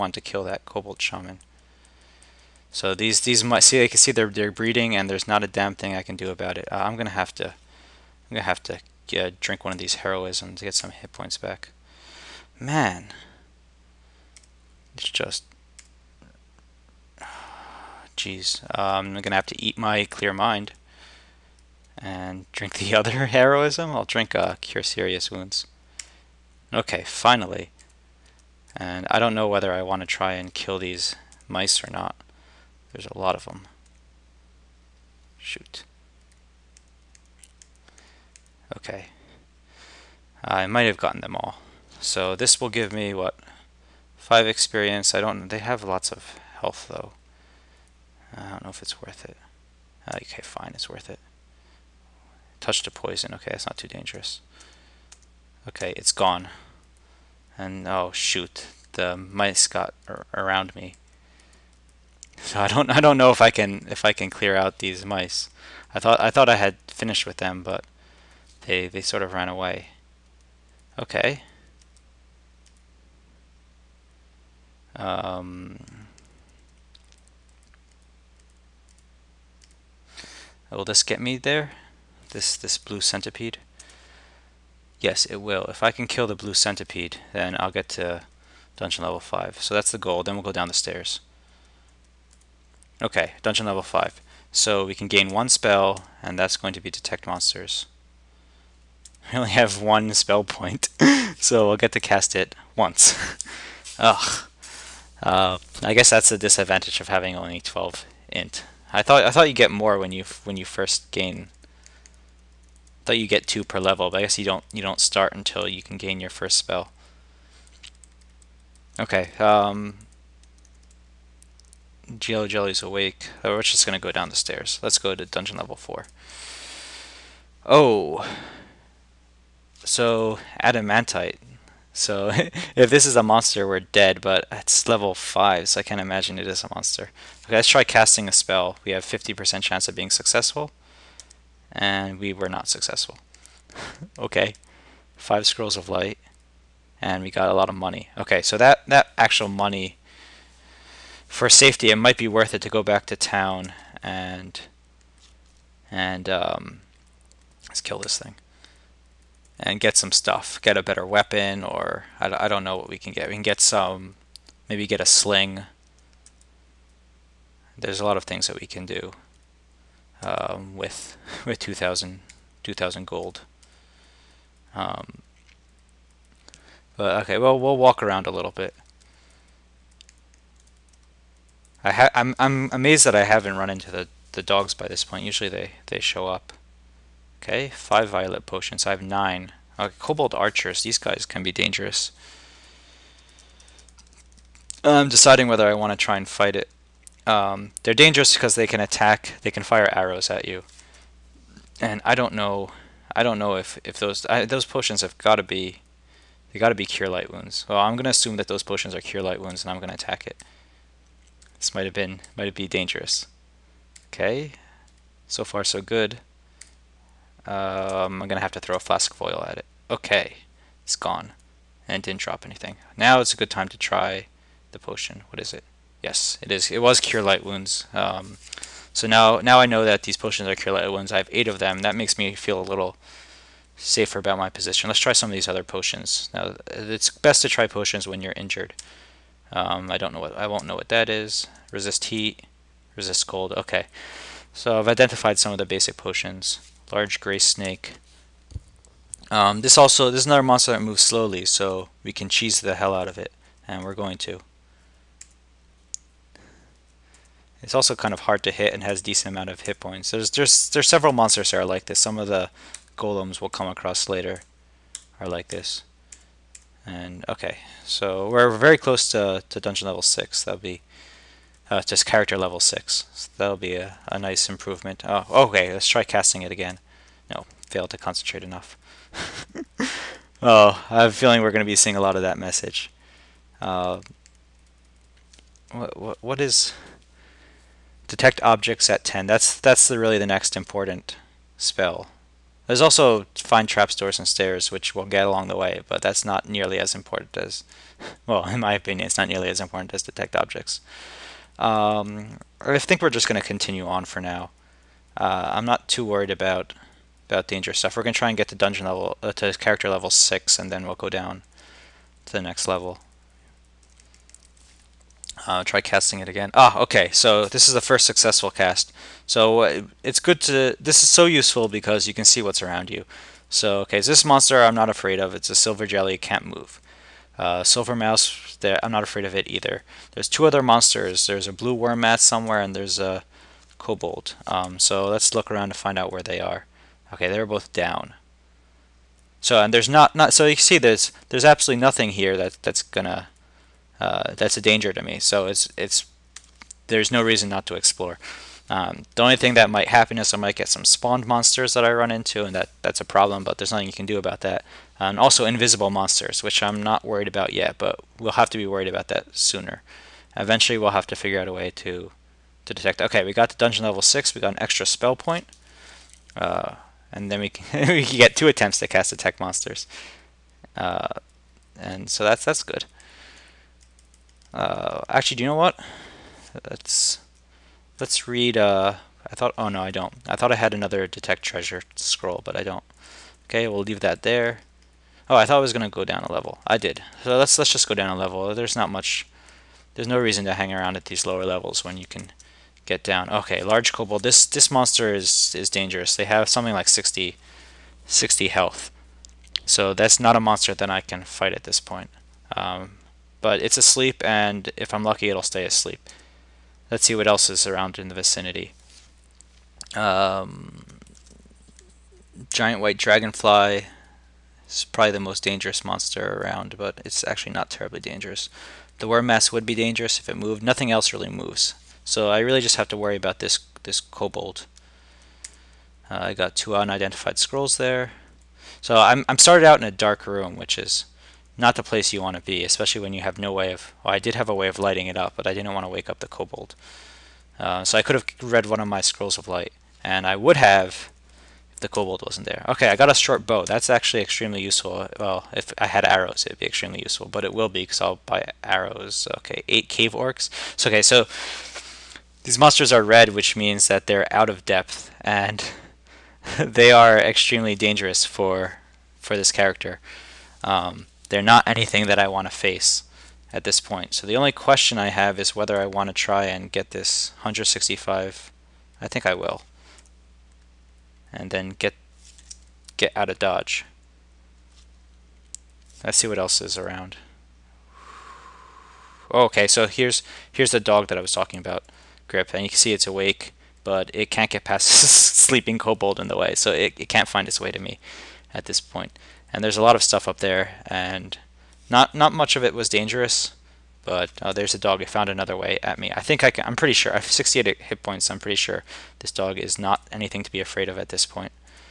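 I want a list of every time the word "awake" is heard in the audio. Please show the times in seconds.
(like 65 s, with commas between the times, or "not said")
122 s, 483 s.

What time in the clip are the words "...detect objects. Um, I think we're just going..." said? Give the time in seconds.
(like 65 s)
300 s.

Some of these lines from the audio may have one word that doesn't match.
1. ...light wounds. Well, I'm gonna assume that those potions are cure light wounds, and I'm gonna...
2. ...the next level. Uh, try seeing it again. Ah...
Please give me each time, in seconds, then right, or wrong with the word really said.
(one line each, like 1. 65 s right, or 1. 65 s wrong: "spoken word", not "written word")
1. 207 s right
2. 312 s wrong: "casting", not "seeing".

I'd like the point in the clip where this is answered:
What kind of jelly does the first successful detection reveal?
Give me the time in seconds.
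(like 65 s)
325 s.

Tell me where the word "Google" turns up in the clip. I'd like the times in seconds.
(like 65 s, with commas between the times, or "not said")
not said.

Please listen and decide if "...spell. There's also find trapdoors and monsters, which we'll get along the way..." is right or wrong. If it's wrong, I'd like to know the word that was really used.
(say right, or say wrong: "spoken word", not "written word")
wrong: "stairs", not "monsters".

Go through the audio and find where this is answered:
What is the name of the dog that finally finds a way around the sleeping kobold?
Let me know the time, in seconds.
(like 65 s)
482 s.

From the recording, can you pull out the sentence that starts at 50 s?
Uh, okay, fine, it's worth it.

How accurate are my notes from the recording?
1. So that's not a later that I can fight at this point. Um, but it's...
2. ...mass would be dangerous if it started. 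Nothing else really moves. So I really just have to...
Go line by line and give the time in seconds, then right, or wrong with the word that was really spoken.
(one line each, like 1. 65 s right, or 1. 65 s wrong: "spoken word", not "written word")
1. 399 s wrong: "monster", not "later"
2. 419 s wrong: "moved", not "started".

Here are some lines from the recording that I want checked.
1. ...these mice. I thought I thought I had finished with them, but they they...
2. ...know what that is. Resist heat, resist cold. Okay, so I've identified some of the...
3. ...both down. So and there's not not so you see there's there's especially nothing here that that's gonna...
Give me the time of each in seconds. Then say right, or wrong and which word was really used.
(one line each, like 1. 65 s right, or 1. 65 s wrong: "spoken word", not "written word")
1. 64 s right
2. 240 s right
3. 337 s wrong: "absolutely", not "especially".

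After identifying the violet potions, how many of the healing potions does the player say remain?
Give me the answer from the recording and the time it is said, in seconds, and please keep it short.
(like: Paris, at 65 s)
8, at 231 s.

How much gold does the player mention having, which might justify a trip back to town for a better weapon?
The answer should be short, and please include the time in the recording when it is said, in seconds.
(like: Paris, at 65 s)
2000, at 172 s.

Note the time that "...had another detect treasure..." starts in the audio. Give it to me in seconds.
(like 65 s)
380 s.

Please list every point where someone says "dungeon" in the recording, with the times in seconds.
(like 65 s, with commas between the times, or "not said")
88 s, 93 s, 125 s, 269 s, 308 s, 363 s.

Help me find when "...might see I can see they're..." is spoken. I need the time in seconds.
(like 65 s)
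3 s.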